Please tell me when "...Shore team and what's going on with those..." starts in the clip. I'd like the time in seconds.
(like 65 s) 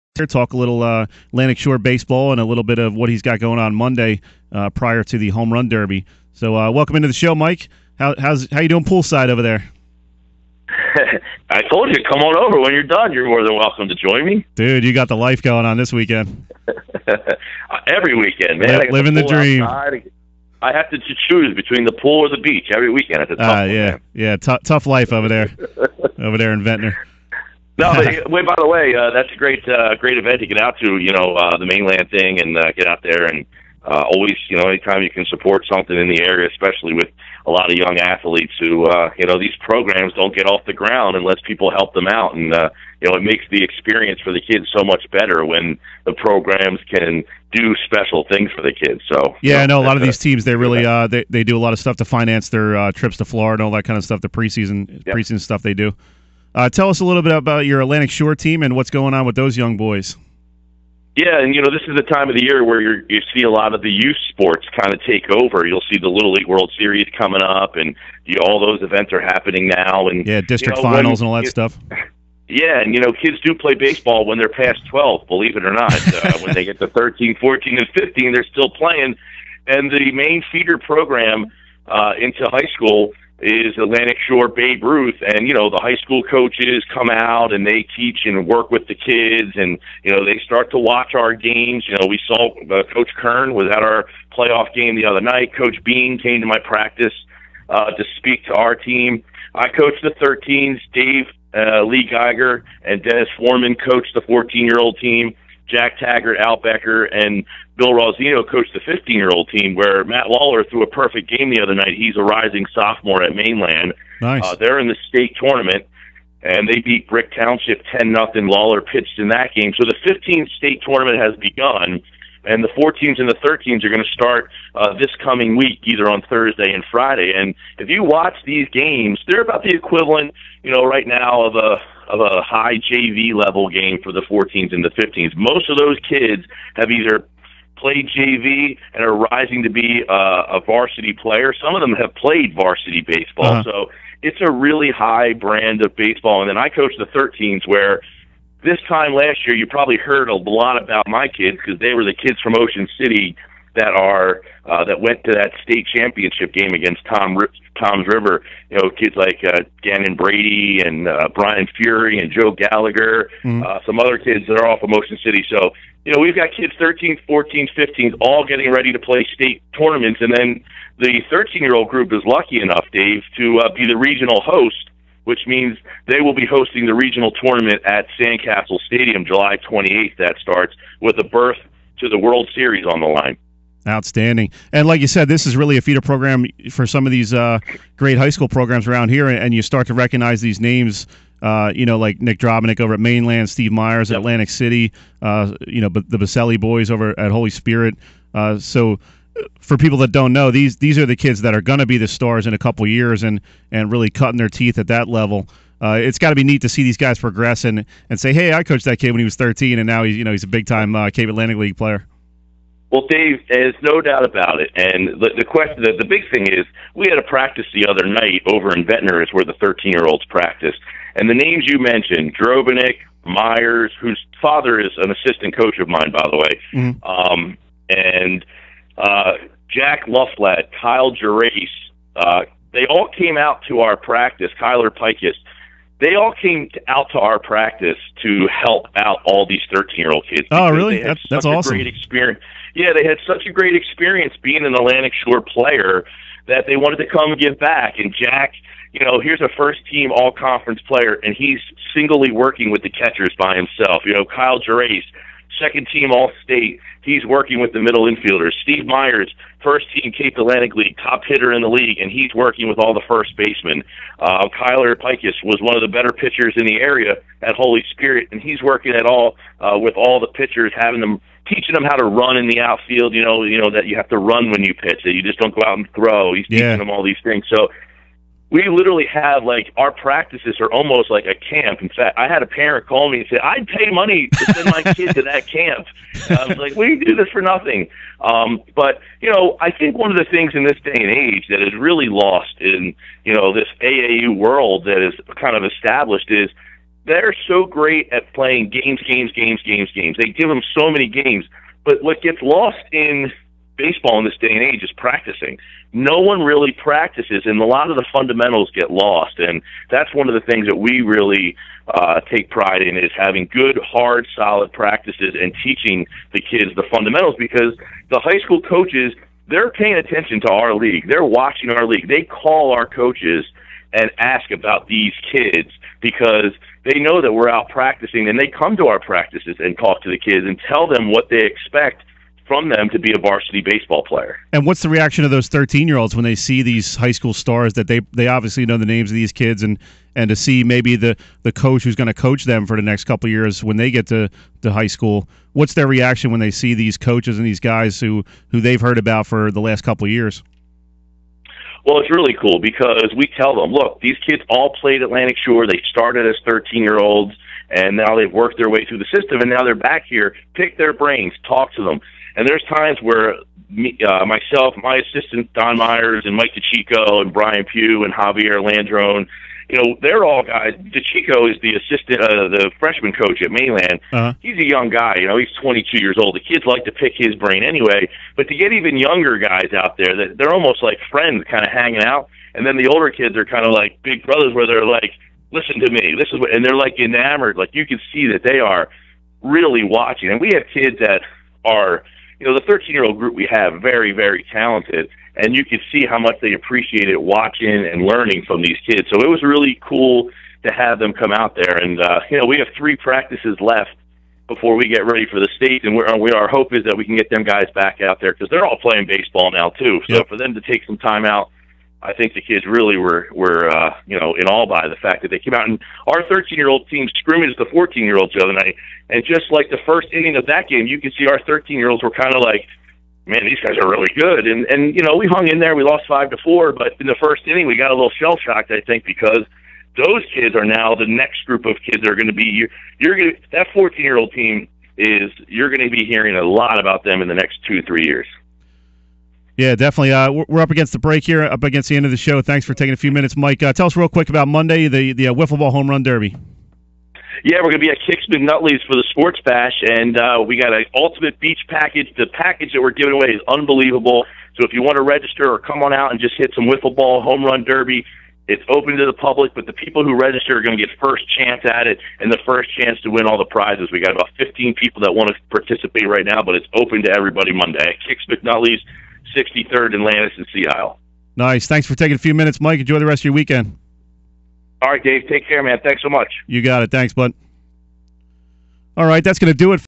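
58 s.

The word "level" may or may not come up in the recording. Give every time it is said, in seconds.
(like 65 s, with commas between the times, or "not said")
133 s, 205 s.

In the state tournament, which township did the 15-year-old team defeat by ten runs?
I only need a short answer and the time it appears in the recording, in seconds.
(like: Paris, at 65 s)
Brick Township, at 117 s.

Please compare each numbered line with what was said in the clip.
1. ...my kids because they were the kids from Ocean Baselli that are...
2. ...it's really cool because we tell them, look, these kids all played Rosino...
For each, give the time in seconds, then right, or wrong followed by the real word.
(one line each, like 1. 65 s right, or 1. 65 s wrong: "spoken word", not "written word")
1. 151 s wrong: "City", not "Baselli"
2. 351 s wrong: "Atlantic", not "Rosino".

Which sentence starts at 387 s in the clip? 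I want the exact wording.
Like you can see that they are really watching.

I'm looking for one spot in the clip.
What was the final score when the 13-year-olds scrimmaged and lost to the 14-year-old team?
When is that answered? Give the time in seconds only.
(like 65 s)
426 s.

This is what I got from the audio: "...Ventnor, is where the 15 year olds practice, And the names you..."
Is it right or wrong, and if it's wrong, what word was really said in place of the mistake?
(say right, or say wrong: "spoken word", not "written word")
wrong: "13", not "15".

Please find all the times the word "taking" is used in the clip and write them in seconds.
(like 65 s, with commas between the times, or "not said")
442 s, 471 s.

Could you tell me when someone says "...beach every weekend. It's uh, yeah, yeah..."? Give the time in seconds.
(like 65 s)
22 s.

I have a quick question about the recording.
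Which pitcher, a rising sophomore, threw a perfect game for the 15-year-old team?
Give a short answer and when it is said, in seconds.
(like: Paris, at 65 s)
Matt Lawler, at 110 s.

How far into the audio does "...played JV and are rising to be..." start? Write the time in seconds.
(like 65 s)
137 s.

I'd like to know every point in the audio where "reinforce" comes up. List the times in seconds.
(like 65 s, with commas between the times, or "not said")
not said.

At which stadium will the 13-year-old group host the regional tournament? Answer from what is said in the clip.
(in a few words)
Sandcastle Stadium.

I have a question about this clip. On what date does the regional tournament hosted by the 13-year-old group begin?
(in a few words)
July 28th.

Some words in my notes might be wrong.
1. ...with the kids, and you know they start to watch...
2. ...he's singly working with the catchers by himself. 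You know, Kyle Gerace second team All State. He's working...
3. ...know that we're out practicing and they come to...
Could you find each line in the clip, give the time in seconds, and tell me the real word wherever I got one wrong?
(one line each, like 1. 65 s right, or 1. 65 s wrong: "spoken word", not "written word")
1. 88 s right
2. 251 s right
3. 326 s right.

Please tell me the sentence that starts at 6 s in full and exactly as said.
So, uh, welcome into the show, Mike.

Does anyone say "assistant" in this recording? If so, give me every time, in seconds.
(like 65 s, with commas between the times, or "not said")
225 s, 364 s, 371 s.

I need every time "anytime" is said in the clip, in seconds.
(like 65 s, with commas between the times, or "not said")
34 s.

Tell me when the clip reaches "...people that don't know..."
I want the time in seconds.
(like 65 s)
199 s.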